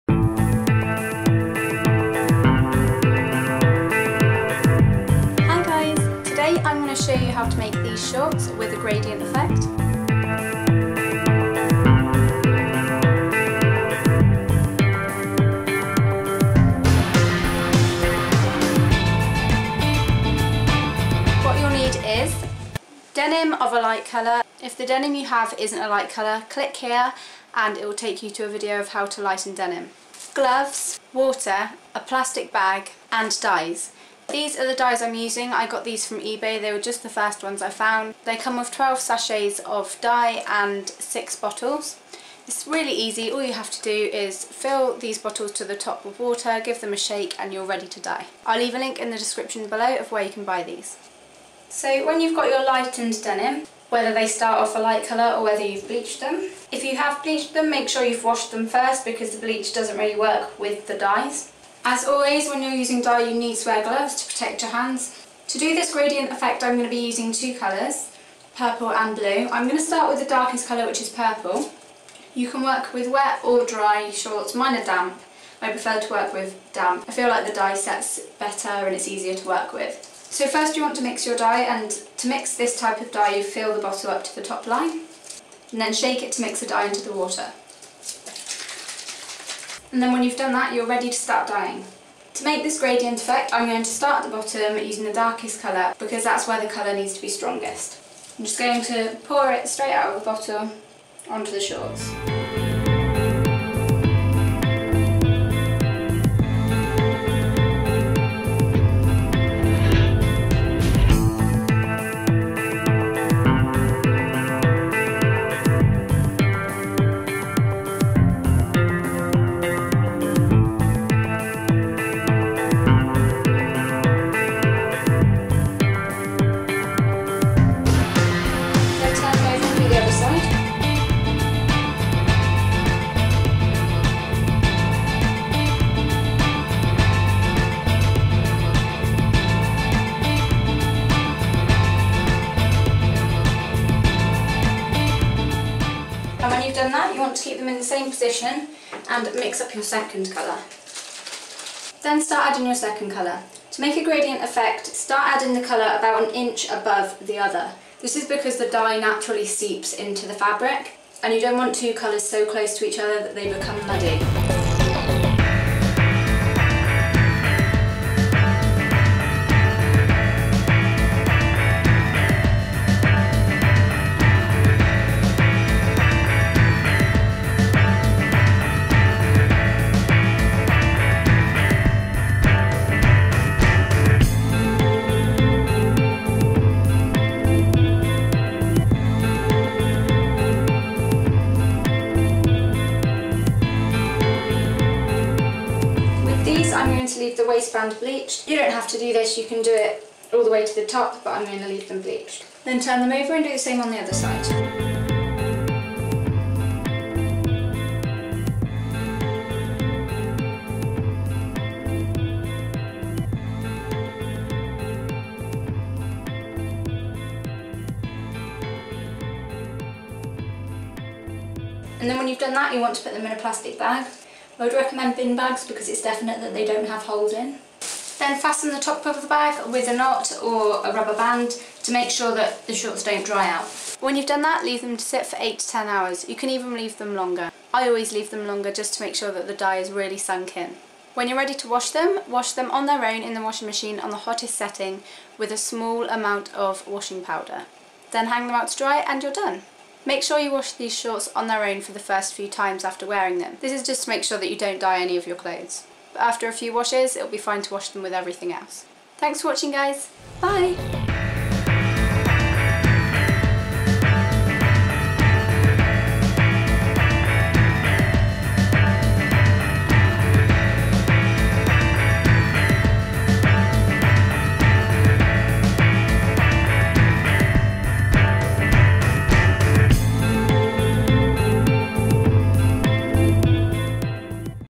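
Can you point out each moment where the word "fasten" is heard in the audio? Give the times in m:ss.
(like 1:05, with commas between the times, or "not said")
3:48.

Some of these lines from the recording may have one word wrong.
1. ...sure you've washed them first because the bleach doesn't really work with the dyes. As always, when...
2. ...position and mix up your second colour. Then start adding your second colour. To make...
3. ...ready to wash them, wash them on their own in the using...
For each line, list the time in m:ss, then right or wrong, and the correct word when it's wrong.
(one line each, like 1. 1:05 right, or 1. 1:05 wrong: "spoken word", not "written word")
1. 0:57 right
2. 2:28 right
3. 4:01 wrong: "washing", not "using".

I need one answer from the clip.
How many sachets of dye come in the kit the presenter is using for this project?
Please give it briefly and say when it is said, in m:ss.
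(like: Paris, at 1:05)
12, at 0:38.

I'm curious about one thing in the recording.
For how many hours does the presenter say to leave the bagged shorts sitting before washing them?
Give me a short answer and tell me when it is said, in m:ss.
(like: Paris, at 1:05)
8 to 10 hours, at 3:55.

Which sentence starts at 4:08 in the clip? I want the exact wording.
Then hang them out to dry and you're done.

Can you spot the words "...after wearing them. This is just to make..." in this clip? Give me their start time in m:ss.
4:12.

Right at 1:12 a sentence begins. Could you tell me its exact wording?
You can work with wet or dry shorts, mine are damp.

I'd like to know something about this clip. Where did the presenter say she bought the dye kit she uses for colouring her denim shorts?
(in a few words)
eBay.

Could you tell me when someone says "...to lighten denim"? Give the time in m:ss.
0:29.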